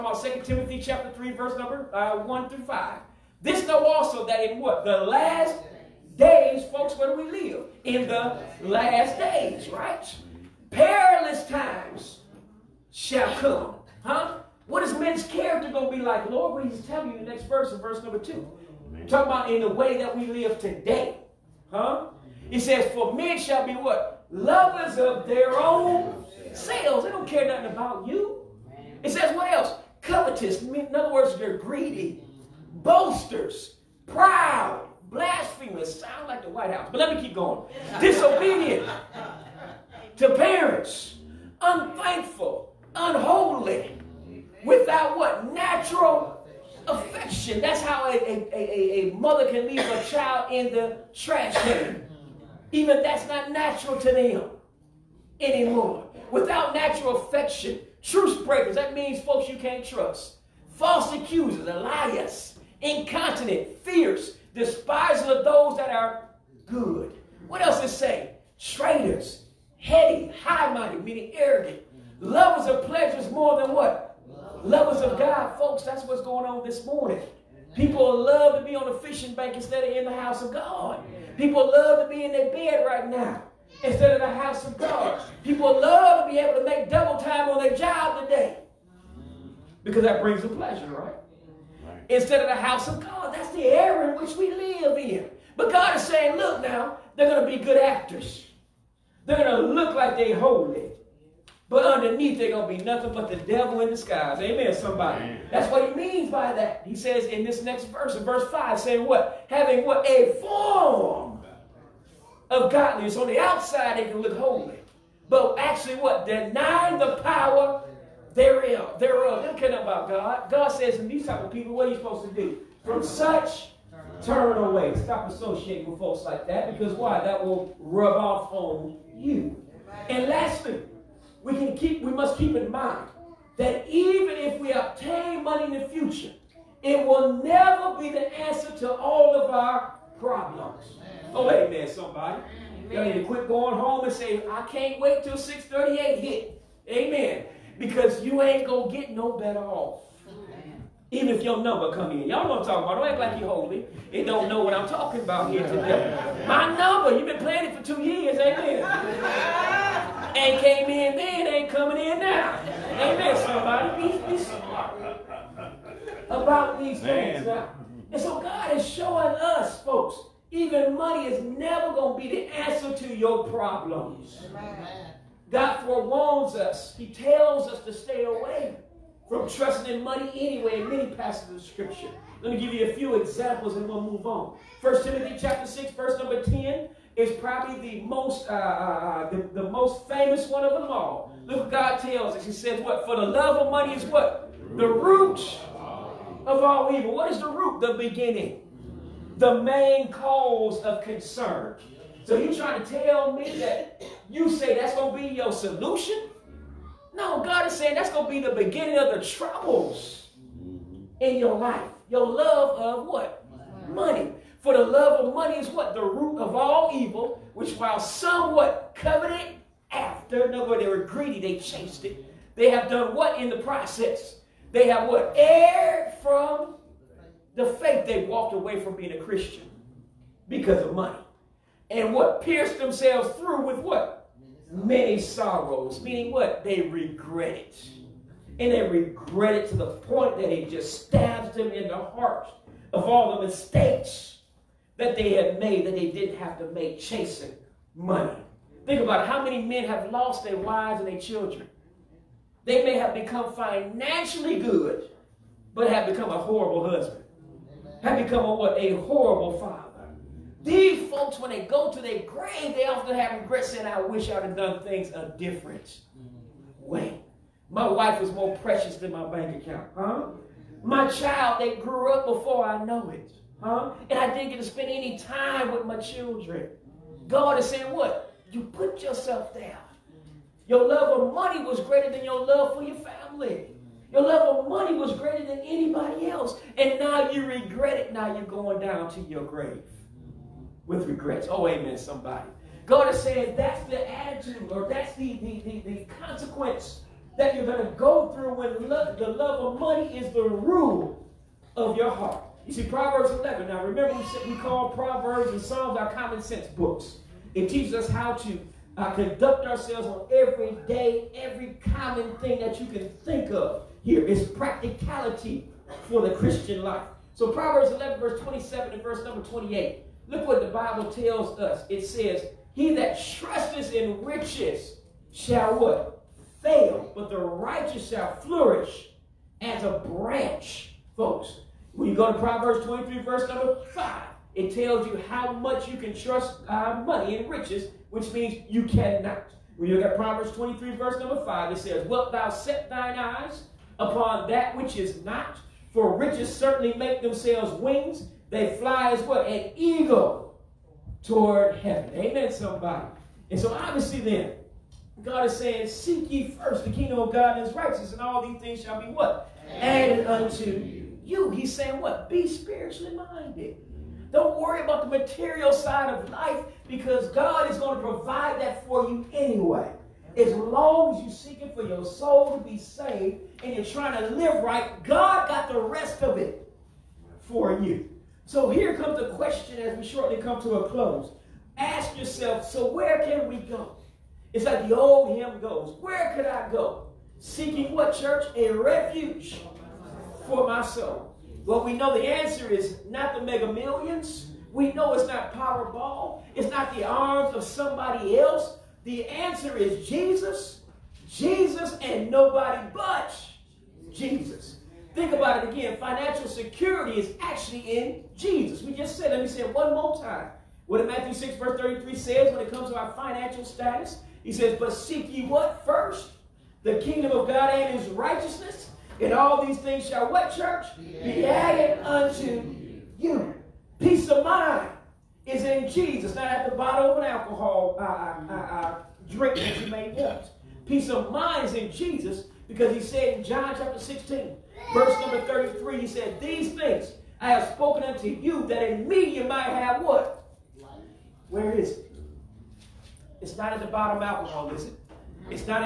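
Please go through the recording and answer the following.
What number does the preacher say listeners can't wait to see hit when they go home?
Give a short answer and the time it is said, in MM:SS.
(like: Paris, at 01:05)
638, at 02:25.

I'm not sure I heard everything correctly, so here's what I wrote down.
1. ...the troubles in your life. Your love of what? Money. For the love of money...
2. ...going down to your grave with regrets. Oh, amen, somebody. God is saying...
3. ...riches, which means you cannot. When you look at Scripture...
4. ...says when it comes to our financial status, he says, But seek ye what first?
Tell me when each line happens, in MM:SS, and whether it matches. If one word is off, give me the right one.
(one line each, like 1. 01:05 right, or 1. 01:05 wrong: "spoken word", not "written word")
1. 03:29 right
2. 04:48 right
3. 05:37 wrong: "Proverbs", not "Scripture"
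4. 06:52 right.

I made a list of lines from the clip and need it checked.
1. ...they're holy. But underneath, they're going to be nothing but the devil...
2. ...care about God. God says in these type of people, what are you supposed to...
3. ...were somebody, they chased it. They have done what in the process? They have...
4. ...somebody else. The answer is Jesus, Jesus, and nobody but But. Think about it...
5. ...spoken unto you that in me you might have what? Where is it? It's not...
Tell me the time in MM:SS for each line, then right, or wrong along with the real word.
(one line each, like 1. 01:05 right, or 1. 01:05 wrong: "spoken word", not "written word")
1. 01:40 right
2. 01:59 right
3. 03:40 wrong: "greedy", not "somebody"
4. 06:37 wrong: "Jesus", not "But"
5. 07:17 right.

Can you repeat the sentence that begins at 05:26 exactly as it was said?
Fail, but the righteous shall flourish as a branch, folks.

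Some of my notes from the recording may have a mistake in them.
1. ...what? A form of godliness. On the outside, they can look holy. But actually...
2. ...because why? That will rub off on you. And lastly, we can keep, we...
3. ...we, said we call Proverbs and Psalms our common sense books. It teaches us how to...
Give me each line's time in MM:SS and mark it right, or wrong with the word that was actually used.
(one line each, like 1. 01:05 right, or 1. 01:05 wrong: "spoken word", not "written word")
1. 01:49 right
2. 02:06 right
3. 05:04 right.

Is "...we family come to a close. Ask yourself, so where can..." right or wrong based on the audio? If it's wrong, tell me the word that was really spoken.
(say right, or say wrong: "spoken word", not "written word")
wrong: "shortly", not "family".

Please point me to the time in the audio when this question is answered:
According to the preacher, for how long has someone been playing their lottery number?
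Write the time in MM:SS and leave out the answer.
02:37.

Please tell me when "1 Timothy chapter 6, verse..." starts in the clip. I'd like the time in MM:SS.
03:04.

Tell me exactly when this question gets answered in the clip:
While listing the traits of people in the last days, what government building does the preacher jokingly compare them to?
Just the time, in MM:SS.
00:36.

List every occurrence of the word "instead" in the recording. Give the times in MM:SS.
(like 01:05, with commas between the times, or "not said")
01:19, 01:23, 01:32.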